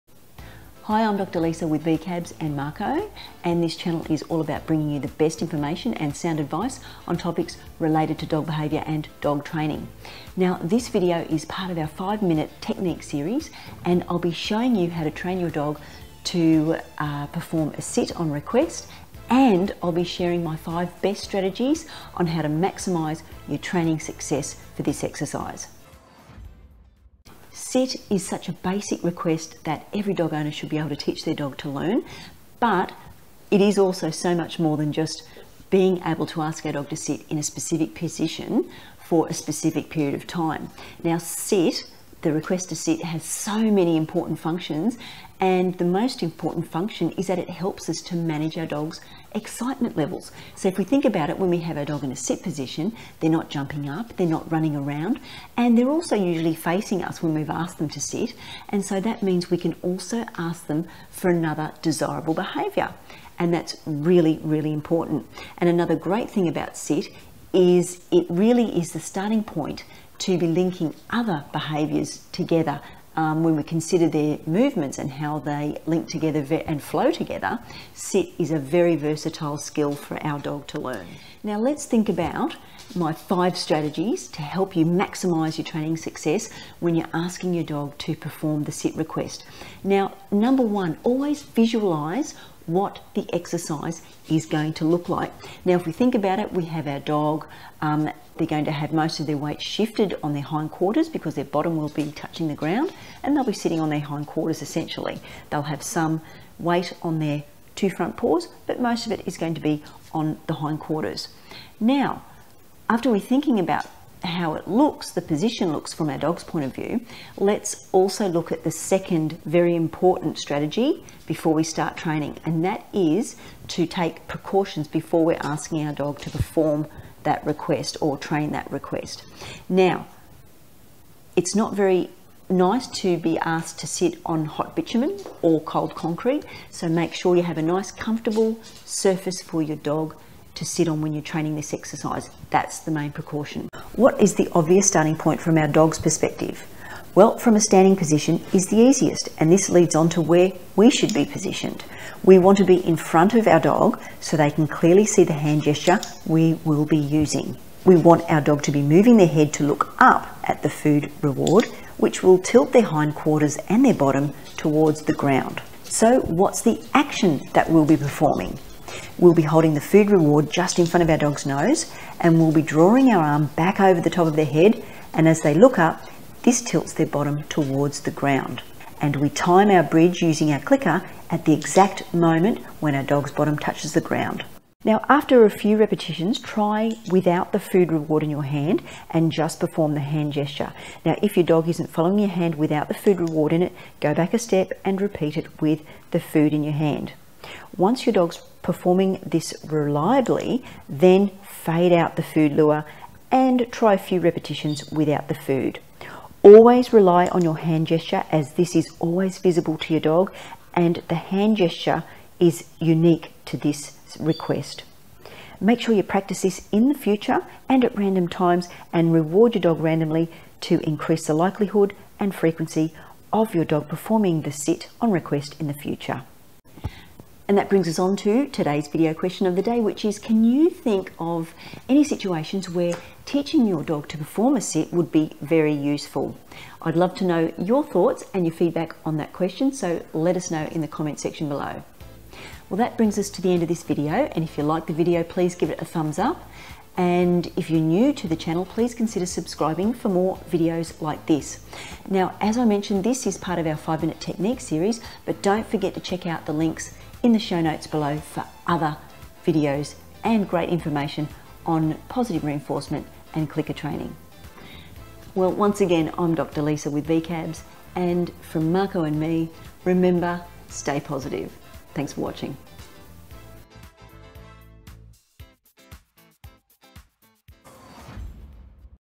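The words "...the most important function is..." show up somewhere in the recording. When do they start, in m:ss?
0:45.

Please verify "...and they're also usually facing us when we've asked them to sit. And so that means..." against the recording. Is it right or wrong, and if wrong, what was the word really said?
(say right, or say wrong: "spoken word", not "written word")
right.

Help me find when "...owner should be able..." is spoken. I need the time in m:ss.
0:30.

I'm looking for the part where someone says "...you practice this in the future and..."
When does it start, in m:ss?
3:35.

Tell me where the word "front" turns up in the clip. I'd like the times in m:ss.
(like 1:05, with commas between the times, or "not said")
1:47, 2:32, 2:50.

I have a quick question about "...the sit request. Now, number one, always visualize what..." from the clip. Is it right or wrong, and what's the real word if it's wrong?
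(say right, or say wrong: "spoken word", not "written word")
right.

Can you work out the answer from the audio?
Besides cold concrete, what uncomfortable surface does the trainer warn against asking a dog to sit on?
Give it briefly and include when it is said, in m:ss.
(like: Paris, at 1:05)
Hot bitumen, at 2:14.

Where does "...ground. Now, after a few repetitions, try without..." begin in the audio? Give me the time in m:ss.
3:04.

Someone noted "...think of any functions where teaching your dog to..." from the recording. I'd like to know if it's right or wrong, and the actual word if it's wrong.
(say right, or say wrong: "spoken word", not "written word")
wrong: "situations", not "functions".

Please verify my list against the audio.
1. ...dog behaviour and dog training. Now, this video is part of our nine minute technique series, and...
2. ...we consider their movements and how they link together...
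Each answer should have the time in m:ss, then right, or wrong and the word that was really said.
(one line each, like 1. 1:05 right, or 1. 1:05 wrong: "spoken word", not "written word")
1. 0:08 wrong: "five", not "nine"
2. 1:13 right.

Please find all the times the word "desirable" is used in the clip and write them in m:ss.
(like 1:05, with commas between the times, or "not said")
1:01.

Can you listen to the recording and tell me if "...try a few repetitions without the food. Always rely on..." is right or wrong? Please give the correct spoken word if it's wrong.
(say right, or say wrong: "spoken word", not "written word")
right.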